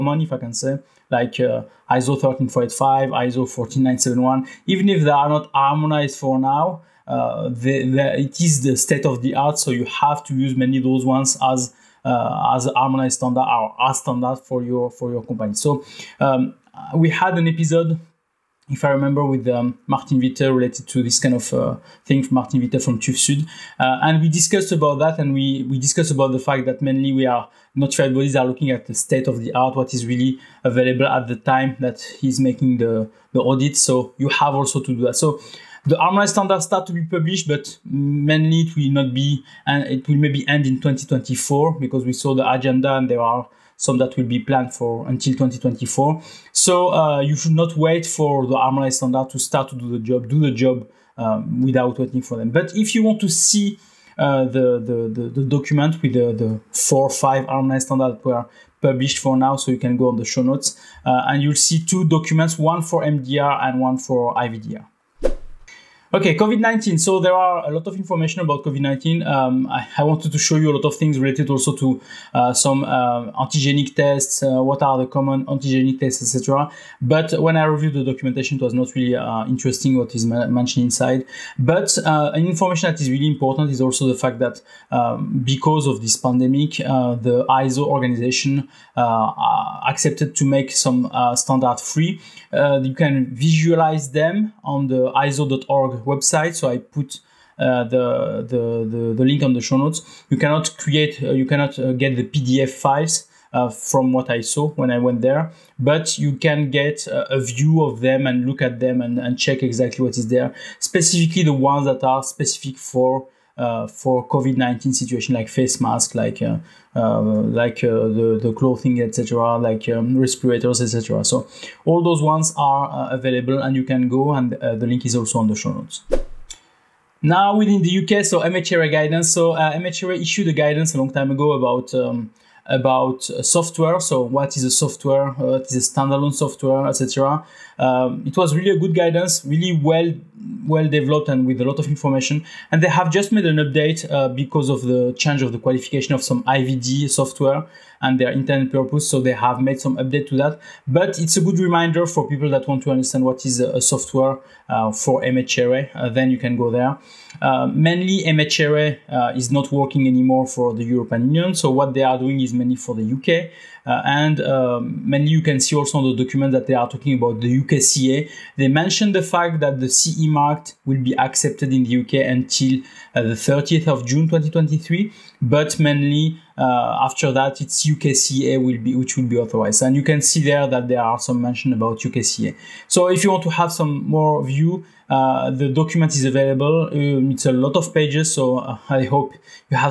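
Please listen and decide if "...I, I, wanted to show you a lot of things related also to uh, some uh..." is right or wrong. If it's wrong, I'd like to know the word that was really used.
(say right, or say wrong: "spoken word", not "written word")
right.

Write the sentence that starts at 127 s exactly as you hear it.
Now within the UK, so MHRA guidance.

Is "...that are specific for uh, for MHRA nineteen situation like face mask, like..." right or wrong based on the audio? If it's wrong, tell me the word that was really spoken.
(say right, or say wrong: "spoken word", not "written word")
wrong: "COVID", not "MHRA".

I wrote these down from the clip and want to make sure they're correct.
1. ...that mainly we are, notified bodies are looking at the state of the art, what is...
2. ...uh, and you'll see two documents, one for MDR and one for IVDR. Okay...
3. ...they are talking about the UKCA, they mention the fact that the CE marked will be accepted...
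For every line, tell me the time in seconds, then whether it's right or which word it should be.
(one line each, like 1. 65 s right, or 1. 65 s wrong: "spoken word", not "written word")
1. 26 s right
2. 61 s right
3. 166 s right.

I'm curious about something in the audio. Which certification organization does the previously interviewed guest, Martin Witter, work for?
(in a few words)
TÜV Sud.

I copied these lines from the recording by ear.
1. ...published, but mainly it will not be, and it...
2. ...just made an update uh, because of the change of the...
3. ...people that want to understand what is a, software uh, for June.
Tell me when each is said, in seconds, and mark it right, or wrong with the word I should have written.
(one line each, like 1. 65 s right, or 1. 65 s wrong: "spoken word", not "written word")
1. 37 s right
2. 143 s right
3. 152 s wrong: "MHRA", not "June".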